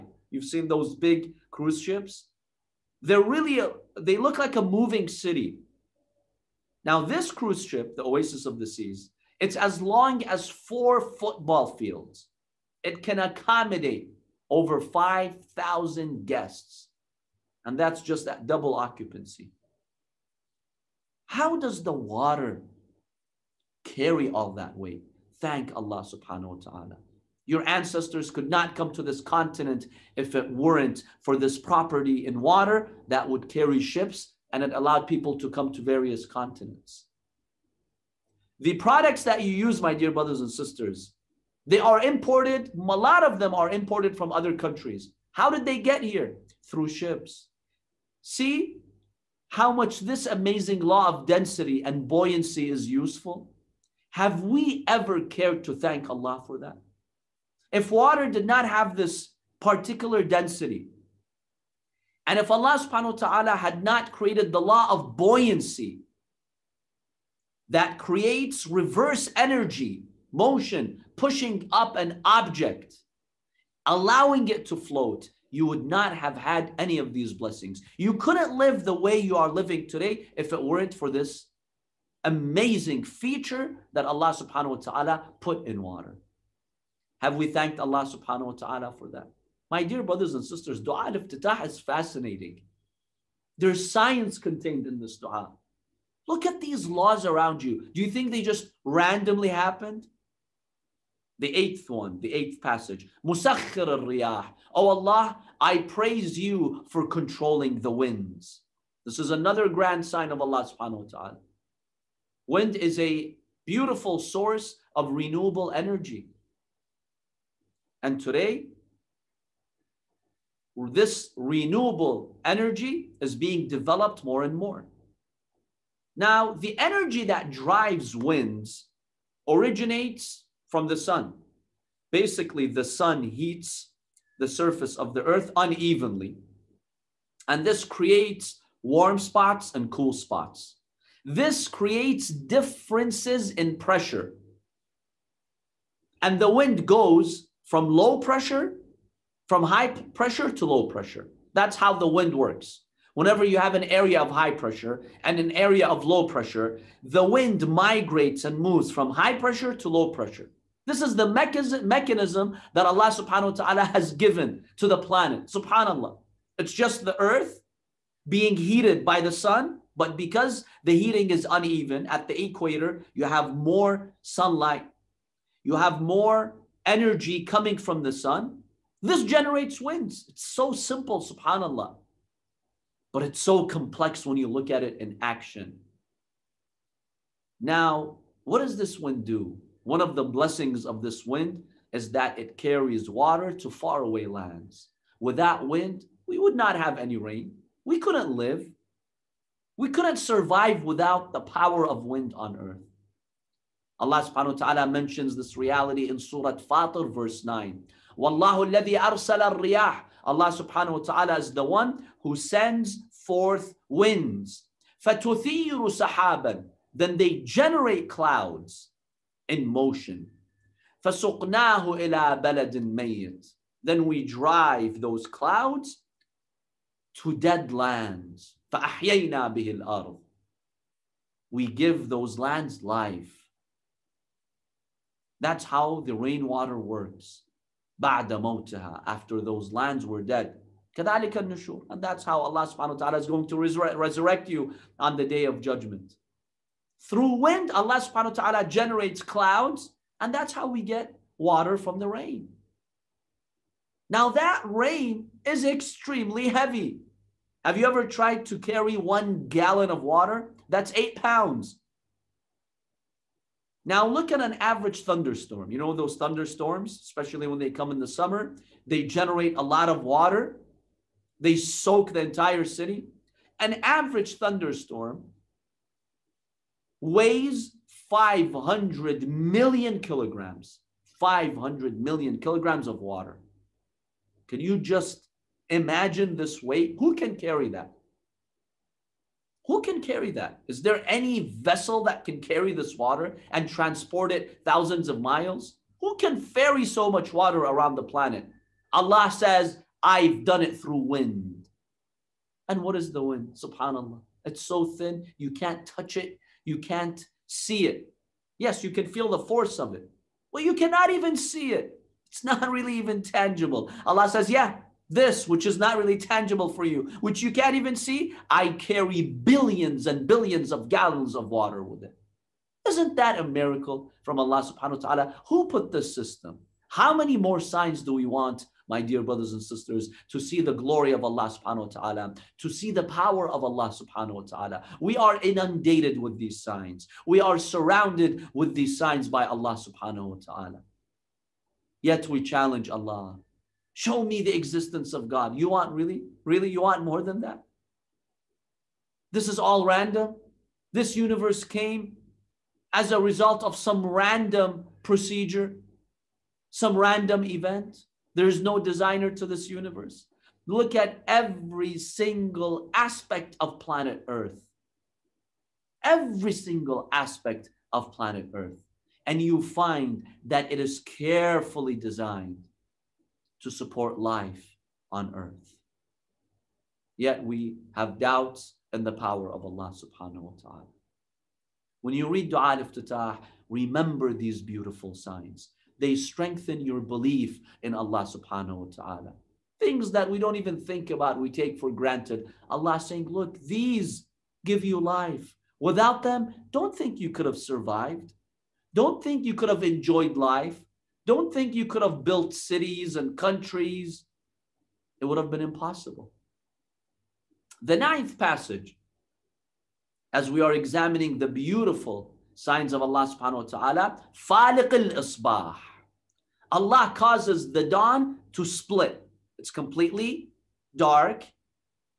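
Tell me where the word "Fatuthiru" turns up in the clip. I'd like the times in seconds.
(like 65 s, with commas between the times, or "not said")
215 s.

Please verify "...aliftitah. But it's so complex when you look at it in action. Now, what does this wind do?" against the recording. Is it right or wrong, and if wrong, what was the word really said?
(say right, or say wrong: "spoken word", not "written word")
wrong: "subhanAllah", not "aliftitah".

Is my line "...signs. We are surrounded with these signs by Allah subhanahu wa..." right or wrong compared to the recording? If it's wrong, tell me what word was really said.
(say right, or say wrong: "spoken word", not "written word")
right.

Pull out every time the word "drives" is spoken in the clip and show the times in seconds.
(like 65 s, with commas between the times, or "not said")
127 s, 224 s.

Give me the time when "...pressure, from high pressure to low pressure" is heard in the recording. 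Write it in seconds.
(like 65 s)
148 s.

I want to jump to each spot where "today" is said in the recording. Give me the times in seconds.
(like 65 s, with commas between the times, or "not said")
79 s, 118 s.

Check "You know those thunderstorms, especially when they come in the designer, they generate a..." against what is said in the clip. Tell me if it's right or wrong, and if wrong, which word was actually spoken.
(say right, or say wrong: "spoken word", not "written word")
wrong: "summer", not "designer".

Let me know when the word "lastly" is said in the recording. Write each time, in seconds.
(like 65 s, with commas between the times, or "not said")
not said.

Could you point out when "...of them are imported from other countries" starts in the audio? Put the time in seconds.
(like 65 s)
43 s.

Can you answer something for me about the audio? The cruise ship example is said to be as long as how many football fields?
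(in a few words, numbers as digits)
4.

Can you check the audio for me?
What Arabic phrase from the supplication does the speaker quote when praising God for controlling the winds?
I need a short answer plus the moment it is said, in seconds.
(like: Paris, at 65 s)
Musakhir al-riyah, at 103 s.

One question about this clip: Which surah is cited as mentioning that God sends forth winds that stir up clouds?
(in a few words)
Surah Fatir.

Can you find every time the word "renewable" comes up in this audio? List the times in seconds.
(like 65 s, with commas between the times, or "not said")
115 s, 121 s.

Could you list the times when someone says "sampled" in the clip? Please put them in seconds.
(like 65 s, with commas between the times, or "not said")
not said.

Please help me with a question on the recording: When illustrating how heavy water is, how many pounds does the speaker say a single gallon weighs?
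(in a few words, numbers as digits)
8 pounds.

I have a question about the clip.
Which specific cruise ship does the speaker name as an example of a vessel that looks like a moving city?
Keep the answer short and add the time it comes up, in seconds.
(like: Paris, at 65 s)
Oasis of the Seas, at 8 s.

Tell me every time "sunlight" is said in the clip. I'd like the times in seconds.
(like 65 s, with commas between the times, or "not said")
174 s.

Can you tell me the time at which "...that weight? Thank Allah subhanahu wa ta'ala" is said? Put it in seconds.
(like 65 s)
24 s.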